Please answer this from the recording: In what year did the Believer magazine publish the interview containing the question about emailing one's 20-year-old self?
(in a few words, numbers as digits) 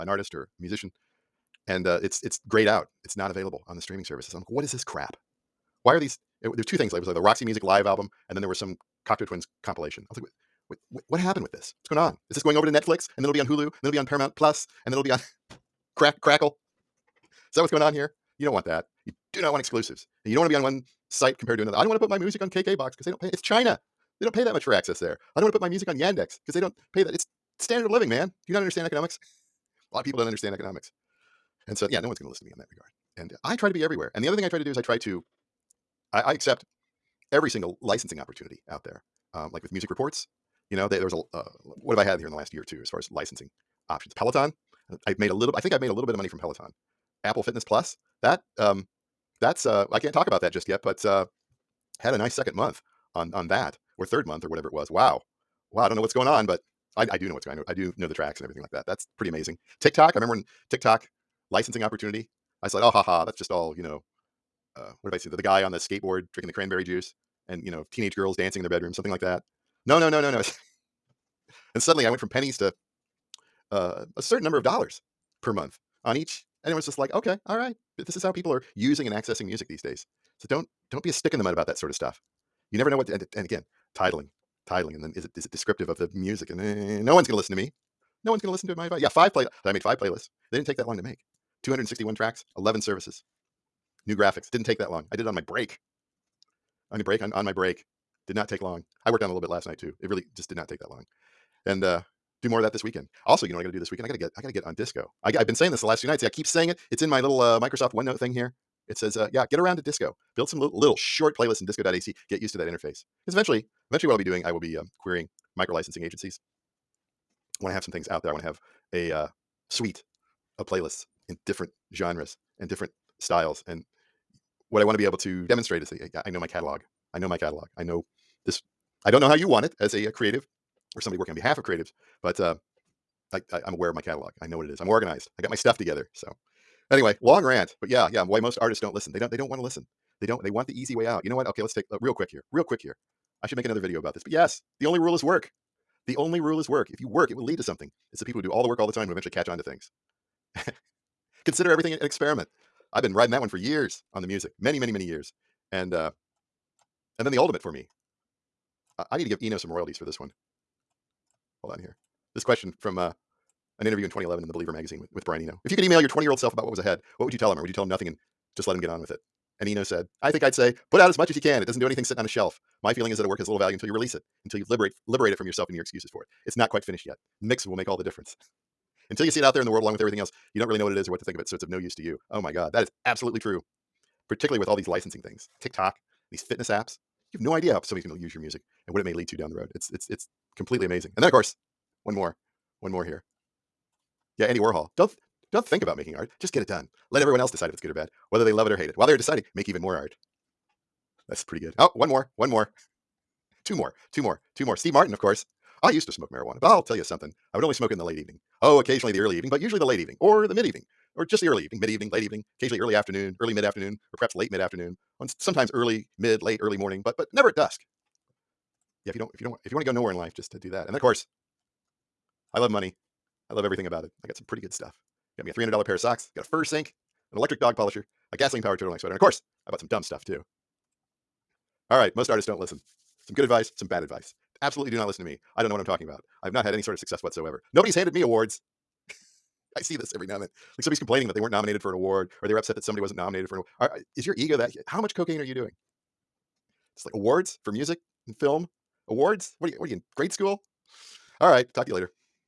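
2011.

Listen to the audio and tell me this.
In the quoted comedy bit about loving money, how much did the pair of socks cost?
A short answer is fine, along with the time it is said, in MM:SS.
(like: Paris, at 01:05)
$300, at 03:45.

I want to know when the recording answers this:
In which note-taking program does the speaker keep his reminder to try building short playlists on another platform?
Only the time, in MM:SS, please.
01:47.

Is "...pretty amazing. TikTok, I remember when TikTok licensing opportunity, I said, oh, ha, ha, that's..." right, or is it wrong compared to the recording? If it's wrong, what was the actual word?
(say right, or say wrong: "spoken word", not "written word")
right.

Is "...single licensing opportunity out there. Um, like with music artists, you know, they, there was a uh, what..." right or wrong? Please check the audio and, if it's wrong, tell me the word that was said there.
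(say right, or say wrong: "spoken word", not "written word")
wrong: "reports", not "artists".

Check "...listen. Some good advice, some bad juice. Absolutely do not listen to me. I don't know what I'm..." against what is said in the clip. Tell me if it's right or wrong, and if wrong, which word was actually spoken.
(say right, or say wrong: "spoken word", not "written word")
wrong: "advice", not "juice".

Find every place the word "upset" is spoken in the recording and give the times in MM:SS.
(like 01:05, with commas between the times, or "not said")
04:02.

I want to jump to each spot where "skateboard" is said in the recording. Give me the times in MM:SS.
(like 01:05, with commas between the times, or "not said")
01:05.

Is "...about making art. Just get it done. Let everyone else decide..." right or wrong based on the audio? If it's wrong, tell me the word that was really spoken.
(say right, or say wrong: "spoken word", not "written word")
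right.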